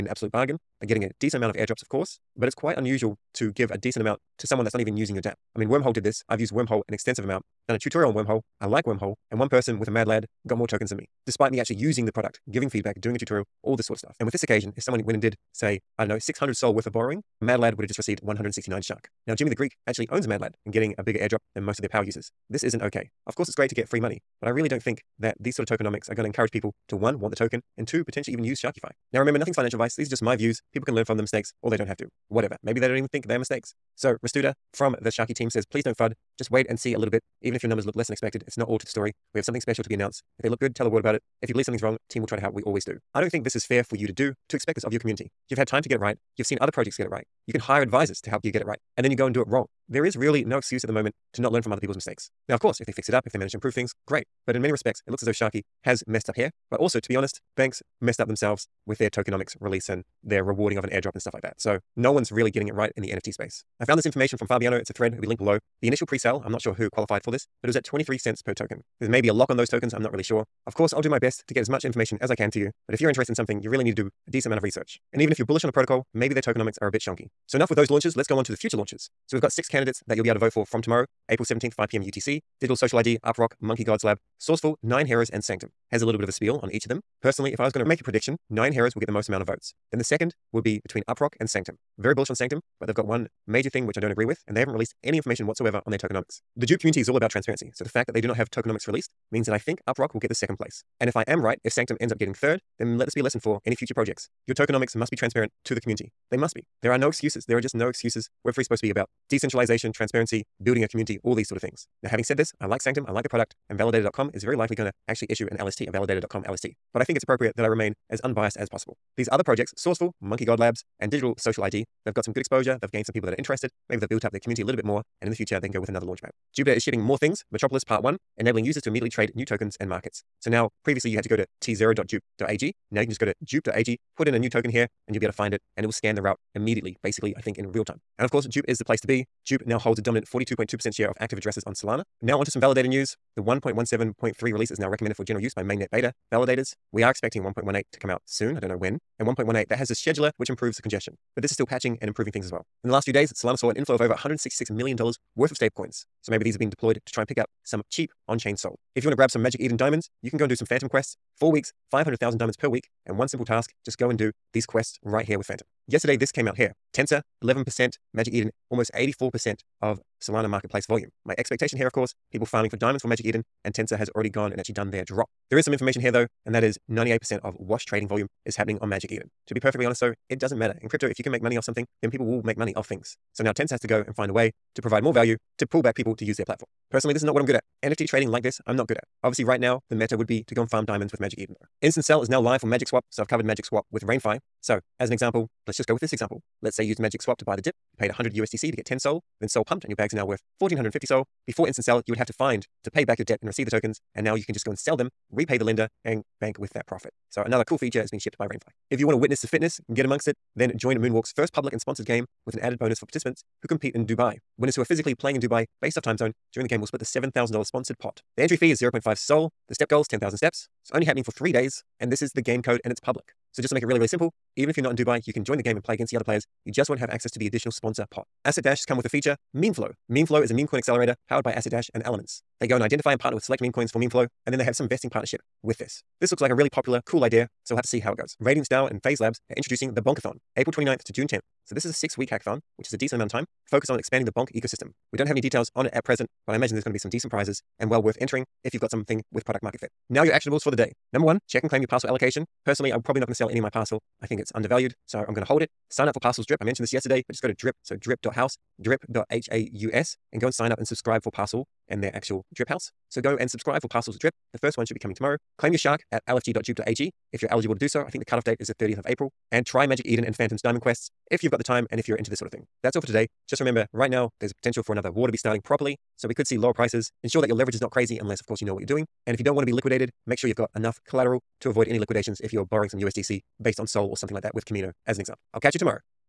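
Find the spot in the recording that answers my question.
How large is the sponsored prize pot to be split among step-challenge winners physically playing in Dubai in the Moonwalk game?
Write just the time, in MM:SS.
03:37.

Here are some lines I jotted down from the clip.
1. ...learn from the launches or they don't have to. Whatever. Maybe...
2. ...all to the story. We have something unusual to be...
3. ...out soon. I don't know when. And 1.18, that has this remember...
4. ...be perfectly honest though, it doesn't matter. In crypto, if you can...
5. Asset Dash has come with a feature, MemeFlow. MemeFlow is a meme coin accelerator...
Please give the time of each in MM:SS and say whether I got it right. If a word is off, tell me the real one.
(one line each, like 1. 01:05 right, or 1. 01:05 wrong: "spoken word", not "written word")
1. 00:30 wrong: "mistakes", not "launches"
2. 00:38 wrong: "special", not "unusual"
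3. 02:28 wrong: "scheduler", not "remember"
4. 02:59 right
5. 03:48 right.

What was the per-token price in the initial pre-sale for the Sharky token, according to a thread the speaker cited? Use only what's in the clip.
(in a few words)
23 cents.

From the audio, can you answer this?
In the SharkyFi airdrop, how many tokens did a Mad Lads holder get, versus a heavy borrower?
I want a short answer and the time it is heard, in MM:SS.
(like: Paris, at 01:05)
169, at 00:18.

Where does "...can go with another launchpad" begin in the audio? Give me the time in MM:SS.
02:05.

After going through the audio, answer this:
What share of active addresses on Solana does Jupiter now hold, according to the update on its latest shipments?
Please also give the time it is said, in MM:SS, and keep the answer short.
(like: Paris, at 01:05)
42.2%, at 02:20.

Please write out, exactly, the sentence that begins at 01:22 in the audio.
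UTC, Digital Social ID, UpRock, Monkey Gods Lab, Sourceful, Nine Heroes, and Sanctum.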